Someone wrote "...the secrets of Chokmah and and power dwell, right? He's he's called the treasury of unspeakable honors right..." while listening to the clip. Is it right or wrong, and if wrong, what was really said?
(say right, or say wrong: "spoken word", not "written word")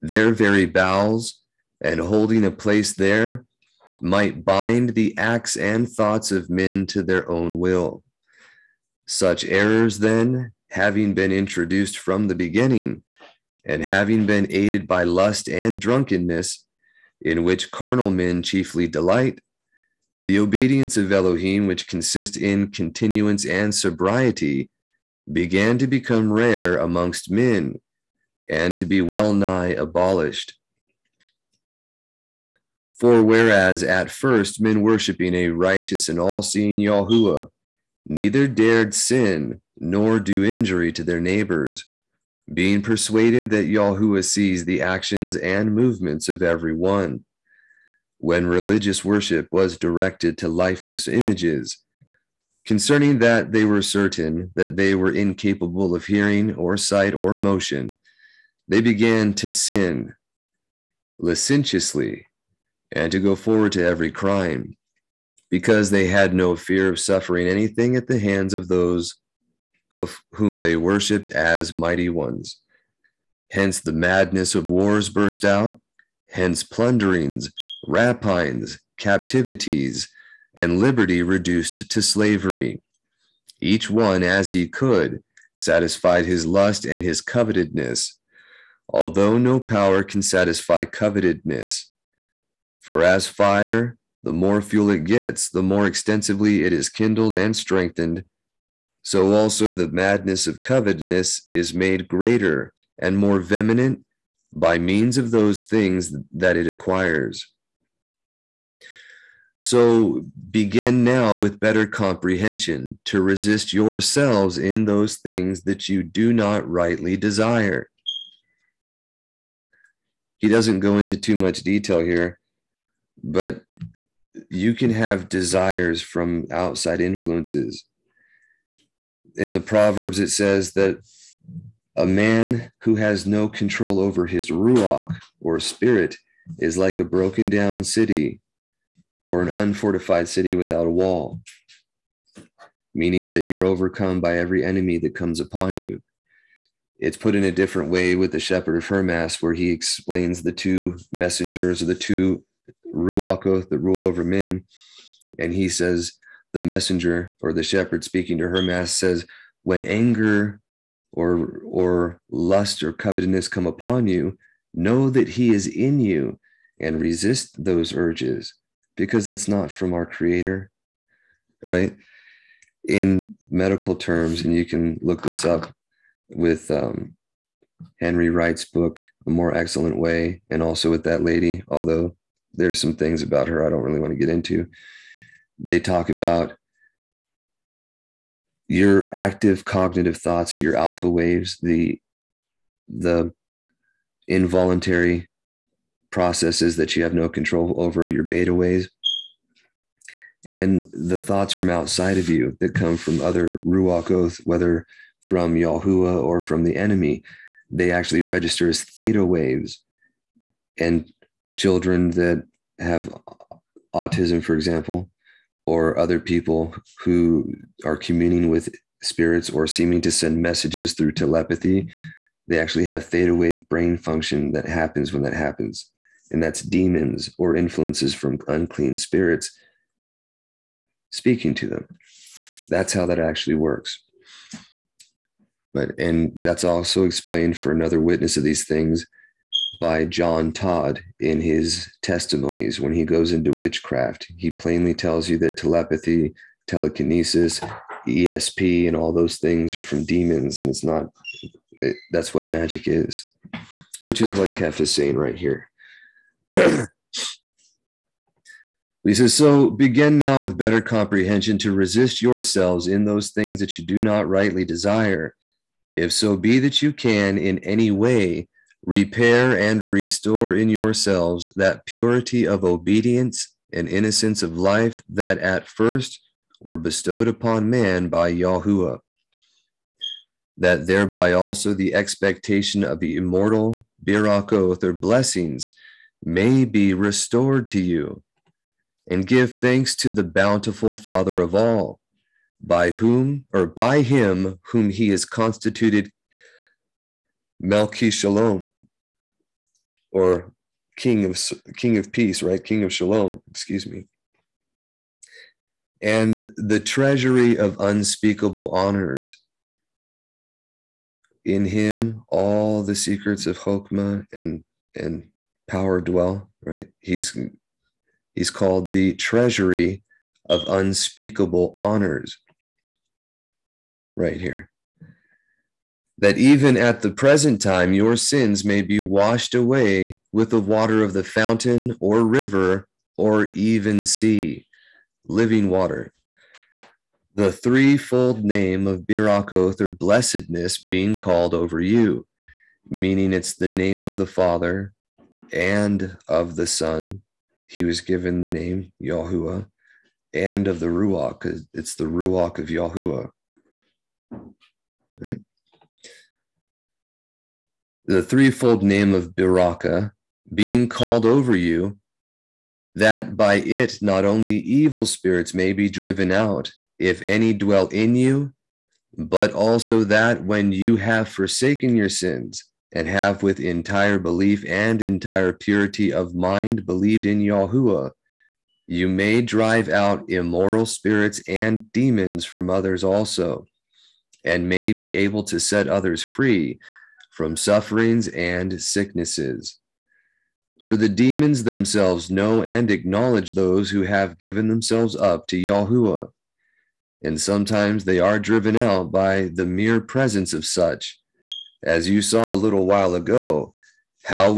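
right.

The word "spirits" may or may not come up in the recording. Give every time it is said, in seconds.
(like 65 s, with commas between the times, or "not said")
135 s, 219 s, 228 s, 365 s, 380 s.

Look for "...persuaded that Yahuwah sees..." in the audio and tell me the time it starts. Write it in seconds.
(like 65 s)
42 s.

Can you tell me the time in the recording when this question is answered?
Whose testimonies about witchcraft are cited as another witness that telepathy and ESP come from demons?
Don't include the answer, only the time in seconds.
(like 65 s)
240 s.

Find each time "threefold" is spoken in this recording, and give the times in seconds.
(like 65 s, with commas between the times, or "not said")
337 s, 358 s.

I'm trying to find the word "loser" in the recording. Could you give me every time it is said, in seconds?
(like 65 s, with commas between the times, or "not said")
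not said.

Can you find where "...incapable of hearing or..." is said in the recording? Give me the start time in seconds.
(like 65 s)
55 s.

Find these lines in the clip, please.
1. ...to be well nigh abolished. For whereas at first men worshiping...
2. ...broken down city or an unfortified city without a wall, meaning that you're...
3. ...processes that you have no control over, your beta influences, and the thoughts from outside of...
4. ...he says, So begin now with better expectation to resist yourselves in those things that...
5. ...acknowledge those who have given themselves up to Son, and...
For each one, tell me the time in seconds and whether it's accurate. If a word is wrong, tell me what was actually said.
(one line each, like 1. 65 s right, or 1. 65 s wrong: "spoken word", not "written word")
1. 28 s right
2. 137 s right
3. 196 s wrong: "waves", not "influences"
4. 259 s wrong: "comprehension", not "expectation"
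5. 392 s wrong: "Yahuwah", not "Son".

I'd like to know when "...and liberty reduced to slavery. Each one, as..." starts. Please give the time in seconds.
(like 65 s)
80 s.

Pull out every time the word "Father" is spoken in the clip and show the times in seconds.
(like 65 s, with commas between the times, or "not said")
290 s, 344 s.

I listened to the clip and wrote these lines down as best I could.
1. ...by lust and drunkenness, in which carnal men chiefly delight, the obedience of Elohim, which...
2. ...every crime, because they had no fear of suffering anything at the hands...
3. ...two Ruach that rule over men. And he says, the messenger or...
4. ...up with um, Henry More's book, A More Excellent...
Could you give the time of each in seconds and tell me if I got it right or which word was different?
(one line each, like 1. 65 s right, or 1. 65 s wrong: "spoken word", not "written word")
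1. 14 s right
2. 63 s right
3. 151 s right
4. 175 s wrong: "Wright", not "More".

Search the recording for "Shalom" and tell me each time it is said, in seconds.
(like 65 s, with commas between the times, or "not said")
298 s, 302 s.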